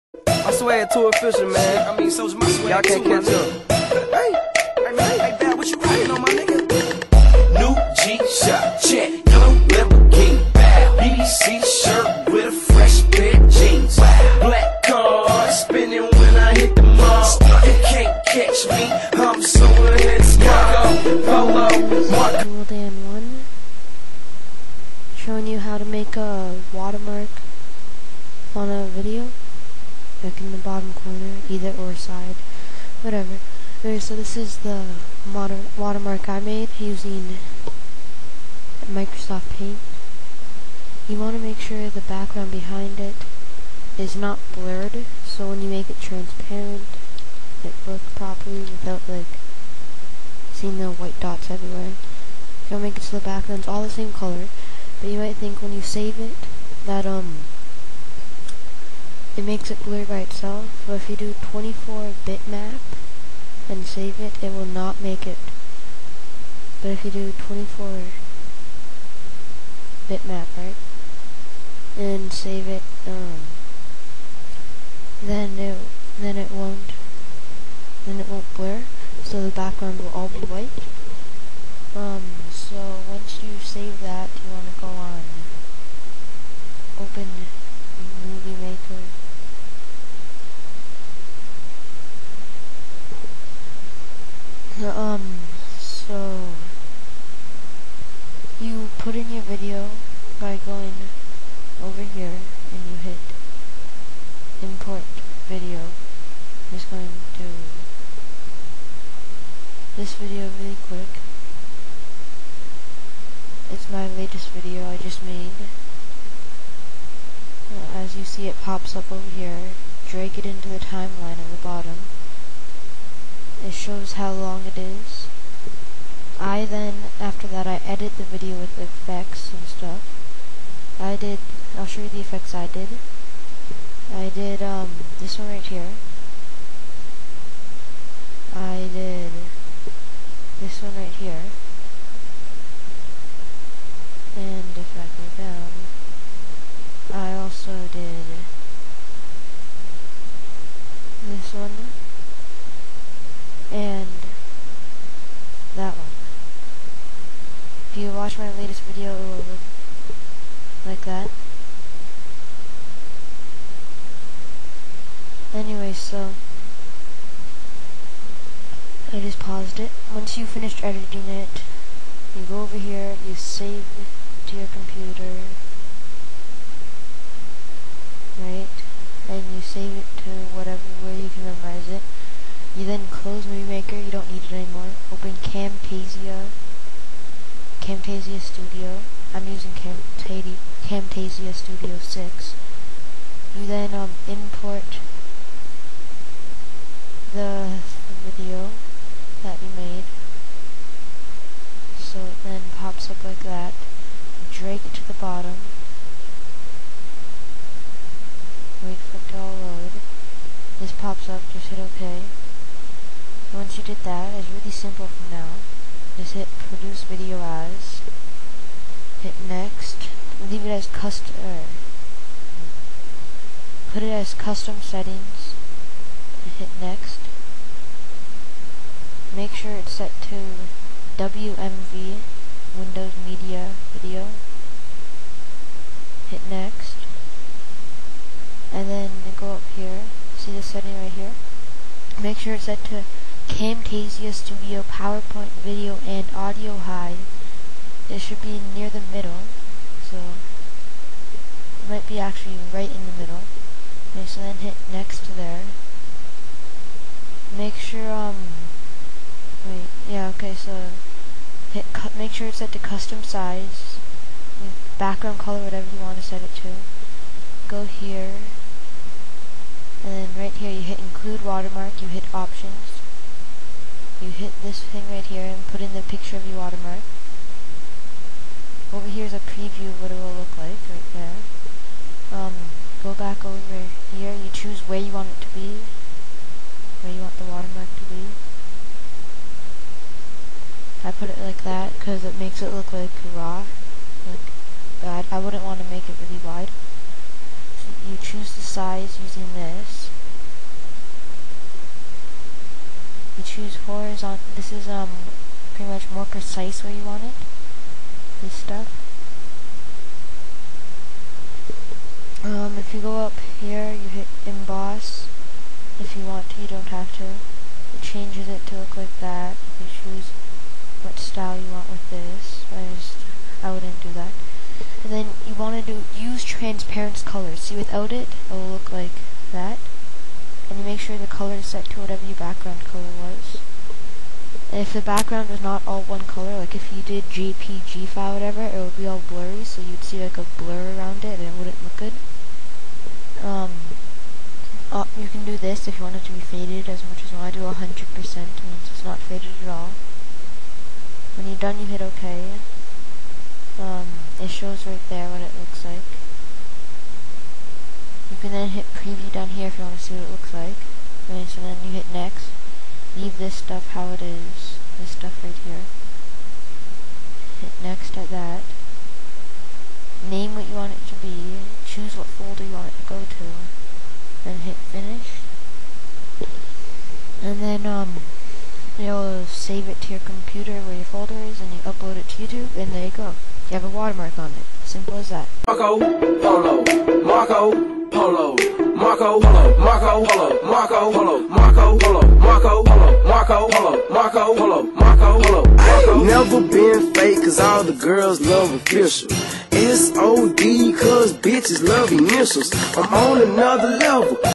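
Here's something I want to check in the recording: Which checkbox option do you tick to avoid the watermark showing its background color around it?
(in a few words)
Use transparent colors.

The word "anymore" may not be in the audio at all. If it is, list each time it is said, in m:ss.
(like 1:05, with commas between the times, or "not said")
3:04.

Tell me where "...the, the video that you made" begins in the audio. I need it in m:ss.
3:17.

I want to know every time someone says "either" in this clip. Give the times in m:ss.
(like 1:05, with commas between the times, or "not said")
0:31.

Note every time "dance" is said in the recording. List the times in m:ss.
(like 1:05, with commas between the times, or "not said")
not said.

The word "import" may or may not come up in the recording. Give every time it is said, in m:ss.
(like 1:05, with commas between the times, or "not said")
1:44, 3:14.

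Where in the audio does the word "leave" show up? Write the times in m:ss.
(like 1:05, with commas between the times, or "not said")
3:40, 6:03.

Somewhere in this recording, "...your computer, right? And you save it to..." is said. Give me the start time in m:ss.
2:54.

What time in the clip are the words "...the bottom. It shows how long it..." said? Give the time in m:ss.
2:01.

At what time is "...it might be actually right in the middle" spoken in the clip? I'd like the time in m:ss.
4:10.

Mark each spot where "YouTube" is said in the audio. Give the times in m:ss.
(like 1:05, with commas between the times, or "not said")
6:22.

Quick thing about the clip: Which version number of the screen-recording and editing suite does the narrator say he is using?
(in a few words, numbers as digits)
6.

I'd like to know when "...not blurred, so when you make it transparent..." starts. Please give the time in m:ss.
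0:44.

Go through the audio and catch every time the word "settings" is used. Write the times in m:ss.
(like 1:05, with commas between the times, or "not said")
3:44, 4:00.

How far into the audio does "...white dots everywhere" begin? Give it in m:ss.
0:50.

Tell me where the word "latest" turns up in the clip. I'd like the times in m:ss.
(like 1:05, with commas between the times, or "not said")
1:54, 2:38.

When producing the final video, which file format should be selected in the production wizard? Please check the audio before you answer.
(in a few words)
WMV.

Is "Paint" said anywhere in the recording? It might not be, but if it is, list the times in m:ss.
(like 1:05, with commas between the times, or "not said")
0:39.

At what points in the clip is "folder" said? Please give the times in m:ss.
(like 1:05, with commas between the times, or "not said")
6:12, 6:21.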